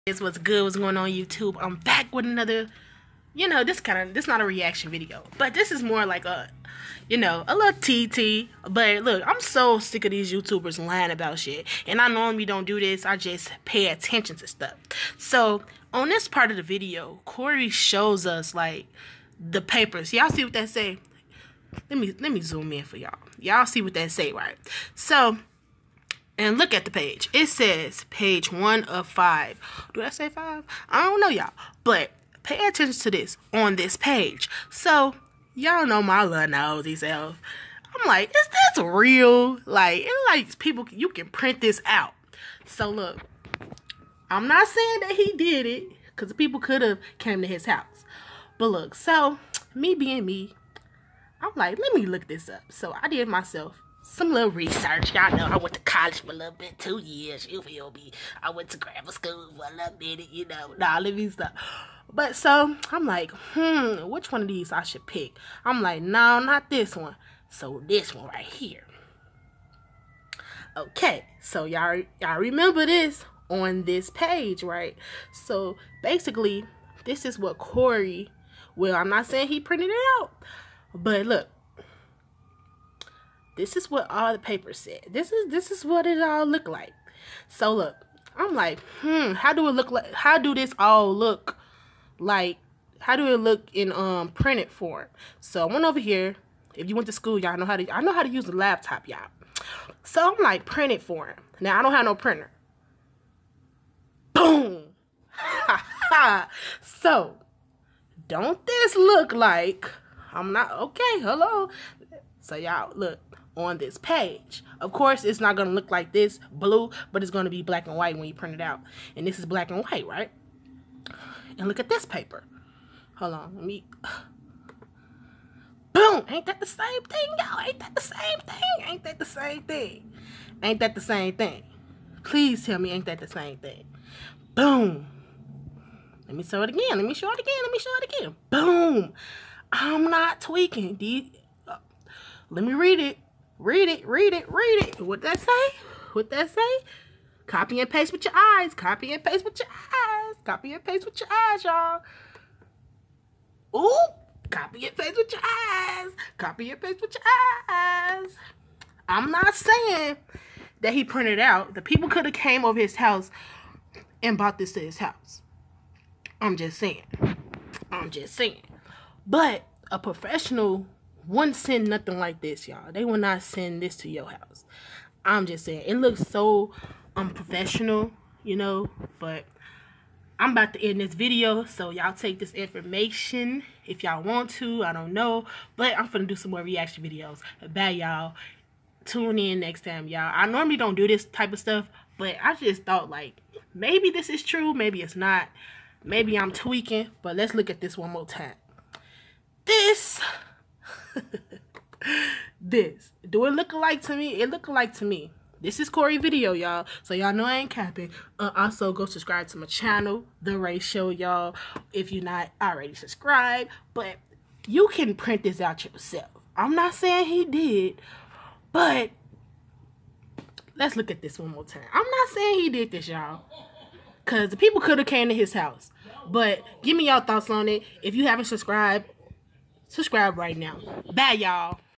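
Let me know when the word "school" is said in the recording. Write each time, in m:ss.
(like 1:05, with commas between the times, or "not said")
0:59, 1:37.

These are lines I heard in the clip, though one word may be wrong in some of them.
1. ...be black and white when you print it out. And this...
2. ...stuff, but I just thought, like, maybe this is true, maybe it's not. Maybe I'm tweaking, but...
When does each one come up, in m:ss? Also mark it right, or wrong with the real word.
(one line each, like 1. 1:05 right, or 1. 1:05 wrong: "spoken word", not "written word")
1. 1:57 right
2. 3:11 right.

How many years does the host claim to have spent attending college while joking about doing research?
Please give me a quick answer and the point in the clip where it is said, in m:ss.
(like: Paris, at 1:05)
2, at 0:56.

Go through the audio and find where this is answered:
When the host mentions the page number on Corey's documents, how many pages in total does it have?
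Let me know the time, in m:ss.
0:28.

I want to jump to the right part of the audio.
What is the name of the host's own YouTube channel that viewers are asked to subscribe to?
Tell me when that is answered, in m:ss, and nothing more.
3:30.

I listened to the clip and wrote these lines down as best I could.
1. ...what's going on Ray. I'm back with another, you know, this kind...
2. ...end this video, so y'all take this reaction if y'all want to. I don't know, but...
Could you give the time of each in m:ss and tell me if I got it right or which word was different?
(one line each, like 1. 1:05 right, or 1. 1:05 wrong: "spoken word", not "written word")
1. 0:00 wrong: "YouTube", not "Ray"
2. 3:00 wrong: "information", not "reaction".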